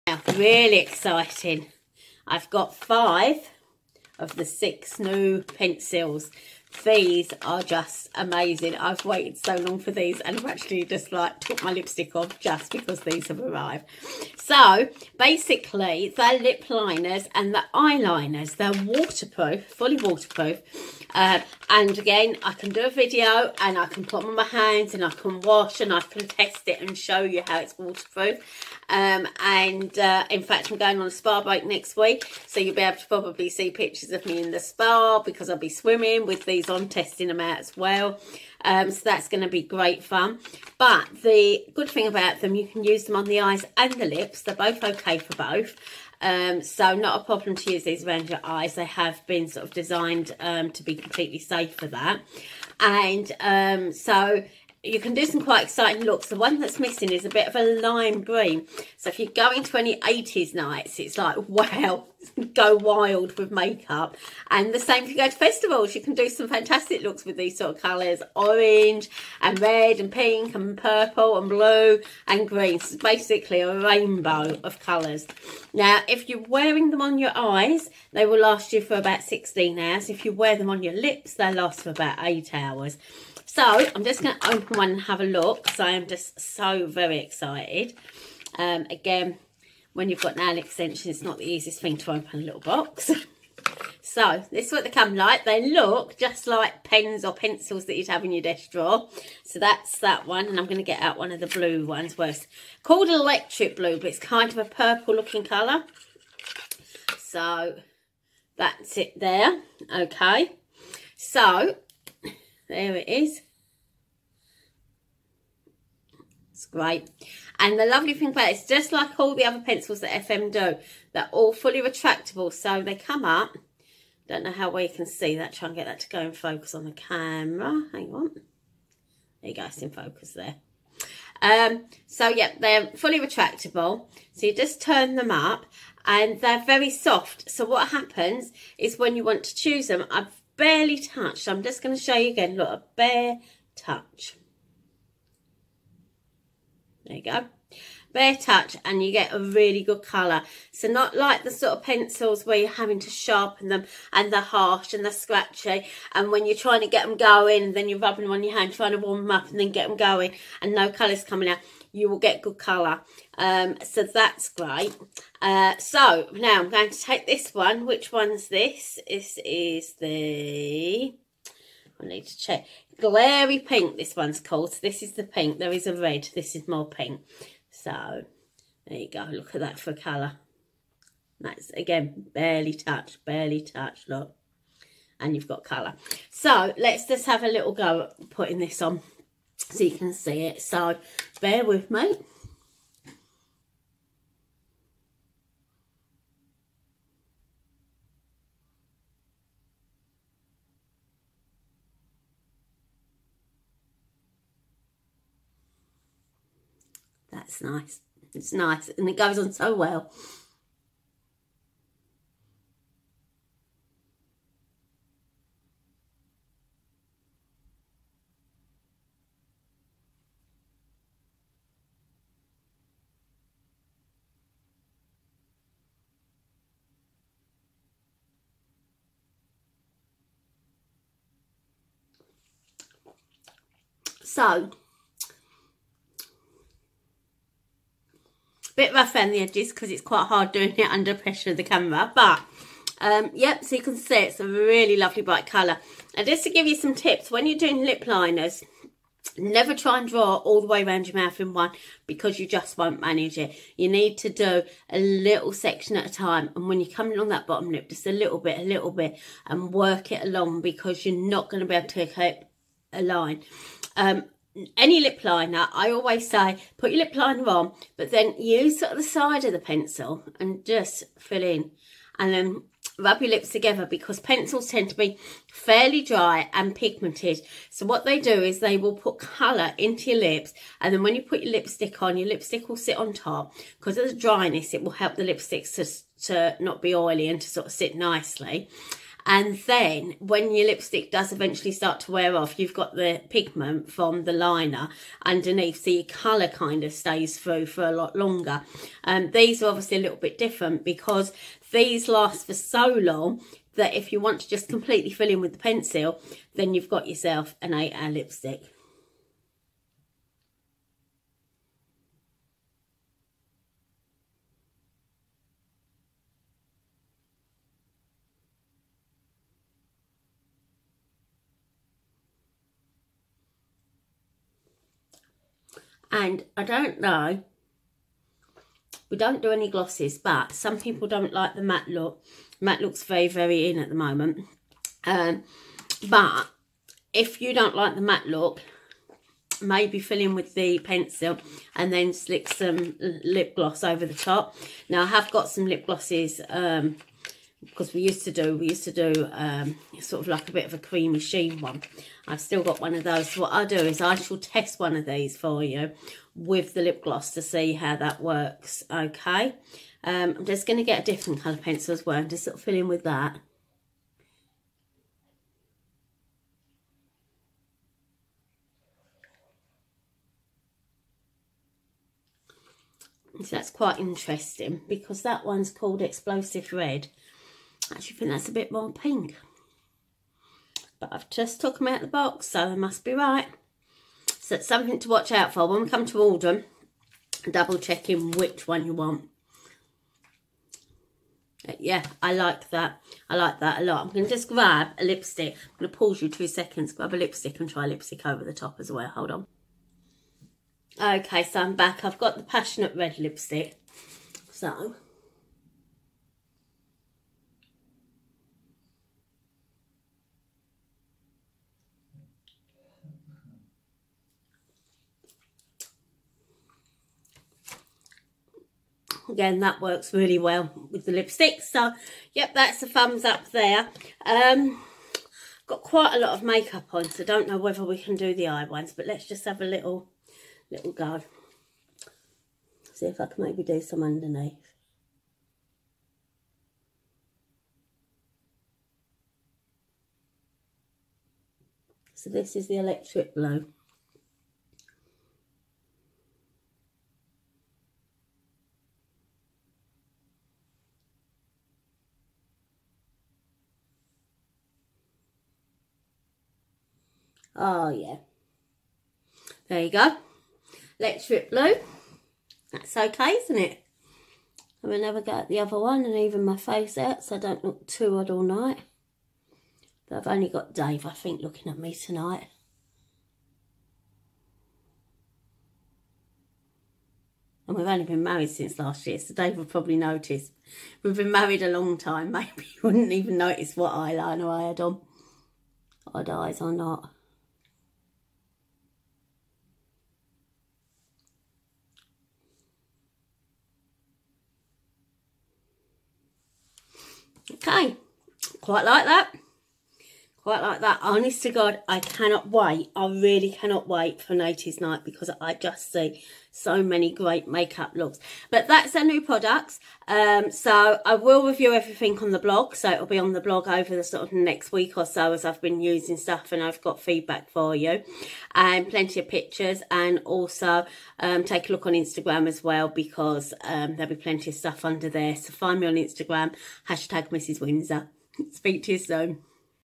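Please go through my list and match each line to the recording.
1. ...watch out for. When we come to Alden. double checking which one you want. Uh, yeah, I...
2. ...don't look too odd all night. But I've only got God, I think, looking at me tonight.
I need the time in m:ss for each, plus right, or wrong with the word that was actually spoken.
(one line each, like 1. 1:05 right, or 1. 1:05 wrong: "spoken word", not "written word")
1. 6:25 right
2. 7:47 wrong: "Dave", not "God".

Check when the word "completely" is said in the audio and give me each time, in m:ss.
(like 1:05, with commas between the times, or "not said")
0:50, 5:04.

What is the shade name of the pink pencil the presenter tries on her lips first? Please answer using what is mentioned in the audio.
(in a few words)
Glary Pink.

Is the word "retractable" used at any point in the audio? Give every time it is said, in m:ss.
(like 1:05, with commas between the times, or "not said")
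2:01, 2:13.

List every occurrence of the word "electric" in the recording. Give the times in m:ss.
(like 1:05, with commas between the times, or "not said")
1:43, 7:22, 7:40.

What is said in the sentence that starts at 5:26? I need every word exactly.
And I don't know, we don't do any glosses, but some people don't like the matte look.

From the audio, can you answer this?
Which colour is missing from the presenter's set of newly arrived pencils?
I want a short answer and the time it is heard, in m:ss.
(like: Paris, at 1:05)
lime green, at 0:57.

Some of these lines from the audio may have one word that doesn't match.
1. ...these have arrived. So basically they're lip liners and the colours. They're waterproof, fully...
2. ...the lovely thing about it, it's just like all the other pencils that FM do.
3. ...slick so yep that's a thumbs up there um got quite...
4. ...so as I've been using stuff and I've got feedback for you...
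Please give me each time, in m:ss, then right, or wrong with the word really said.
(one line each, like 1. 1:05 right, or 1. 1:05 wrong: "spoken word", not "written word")
1. 0:13 wrong: "eyeliners", not "colours"
2. 1:57 right
3. 7:01 wrong: "lipstick", not "slick"
4. 8:35 right.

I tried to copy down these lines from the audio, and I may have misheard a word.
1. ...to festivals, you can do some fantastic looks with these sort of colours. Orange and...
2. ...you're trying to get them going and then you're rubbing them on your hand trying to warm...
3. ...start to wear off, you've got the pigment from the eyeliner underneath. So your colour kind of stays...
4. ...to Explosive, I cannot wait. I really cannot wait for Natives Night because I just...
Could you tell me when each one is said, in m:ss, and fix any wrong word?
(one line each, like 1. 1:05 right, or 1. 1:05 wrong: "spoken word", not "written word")
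1. 1:05 right
2. 2:36 right
3. 4:51 wrong: "liner", not "eyeliner"
4. 8:21 wrong: "God", not "Explosive".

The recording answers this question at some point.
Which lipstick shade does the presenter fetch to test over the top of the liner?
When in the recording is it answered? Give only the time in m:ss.
6:42.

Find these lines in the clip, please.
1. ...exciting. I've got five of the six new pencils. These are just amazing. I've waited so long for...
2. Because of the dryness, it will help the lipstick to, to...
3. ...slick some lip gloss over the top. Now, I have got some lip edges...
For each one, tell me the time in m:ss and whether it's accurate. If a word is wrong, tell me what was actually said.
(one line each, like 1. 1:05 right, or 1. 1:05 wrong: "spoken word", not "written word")
1. 0:00 right
2. 4:43 right
3. 5:42 wrong: "glosses", not "edges".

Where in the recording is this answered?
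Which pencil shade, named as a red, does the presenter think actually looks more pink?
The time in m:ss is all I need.
6:16.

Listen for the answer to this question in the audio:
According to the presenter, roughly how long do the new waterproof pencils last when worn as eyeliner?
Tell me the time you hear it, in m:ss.
1:19.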